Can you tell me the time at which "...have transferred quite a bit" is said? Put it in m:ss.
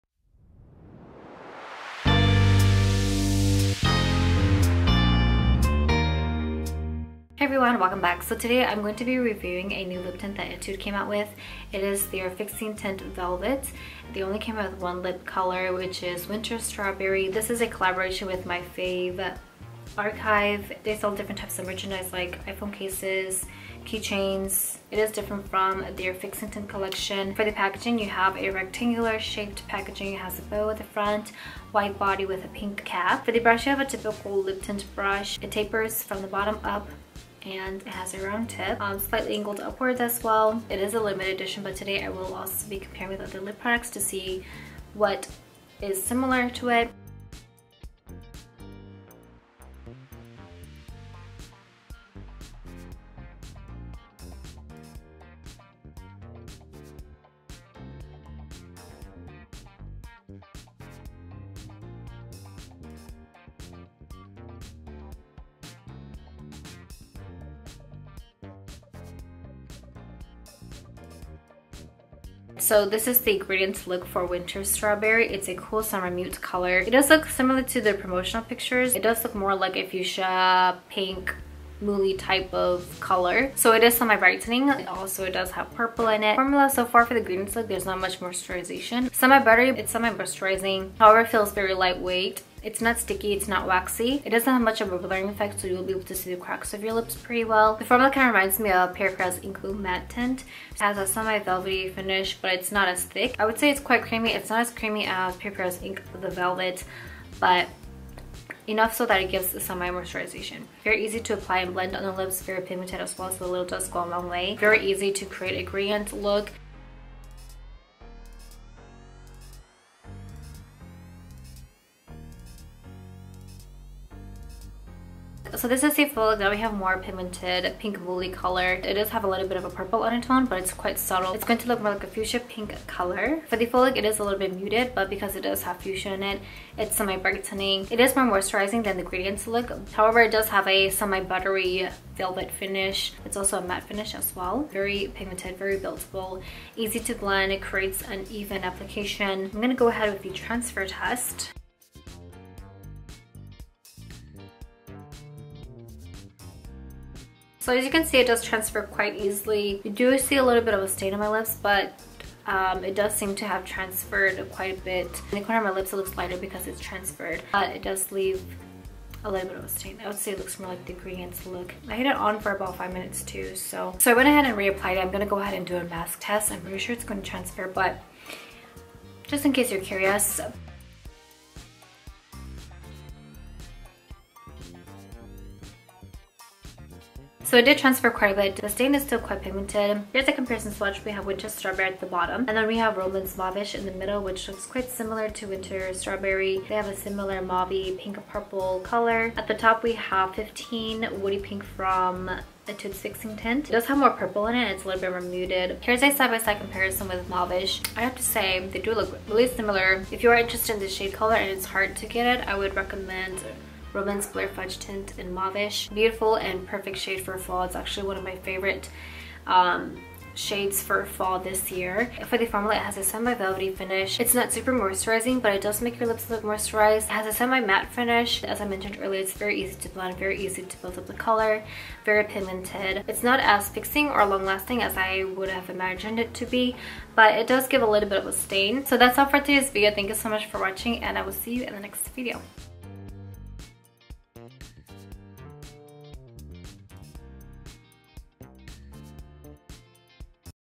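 2:43.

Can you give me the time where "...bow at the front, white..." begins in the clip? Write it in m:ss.
0:30.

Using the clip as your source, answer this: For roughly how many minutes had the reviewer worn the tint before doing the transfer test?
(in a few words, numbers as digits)
5.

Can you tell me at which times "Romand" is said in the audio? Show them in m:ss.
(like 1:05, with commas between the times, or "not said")
3:12, 3:33.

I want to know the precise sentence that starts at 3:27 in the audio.
I have to say, they do look really similar.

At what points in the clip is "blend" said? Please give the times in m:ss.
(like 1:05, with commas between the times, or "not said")
1:51, 2:27, 3:49.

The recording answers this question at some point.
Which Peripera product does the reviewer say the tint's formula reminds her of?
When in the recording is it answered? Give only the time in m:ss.
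1:39.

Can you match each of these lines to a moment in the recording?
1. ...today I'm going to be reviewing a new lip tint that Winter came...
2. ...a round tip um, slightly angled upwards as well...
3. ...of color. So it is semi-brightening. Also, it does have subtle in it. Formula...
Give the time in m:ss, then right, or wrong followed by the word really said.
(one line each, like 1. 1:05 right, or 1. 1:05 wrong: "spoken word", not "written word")
1. 0:08 wrong: "Etude", not "Winter"
2. 0:38 right
3. 1:22 wrong: "purple", not "subtle".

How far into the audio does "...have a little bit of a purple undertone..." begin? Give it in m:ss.
2:09.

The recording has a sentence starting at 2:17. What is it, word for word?
It is more moisturizing than the Gradients look.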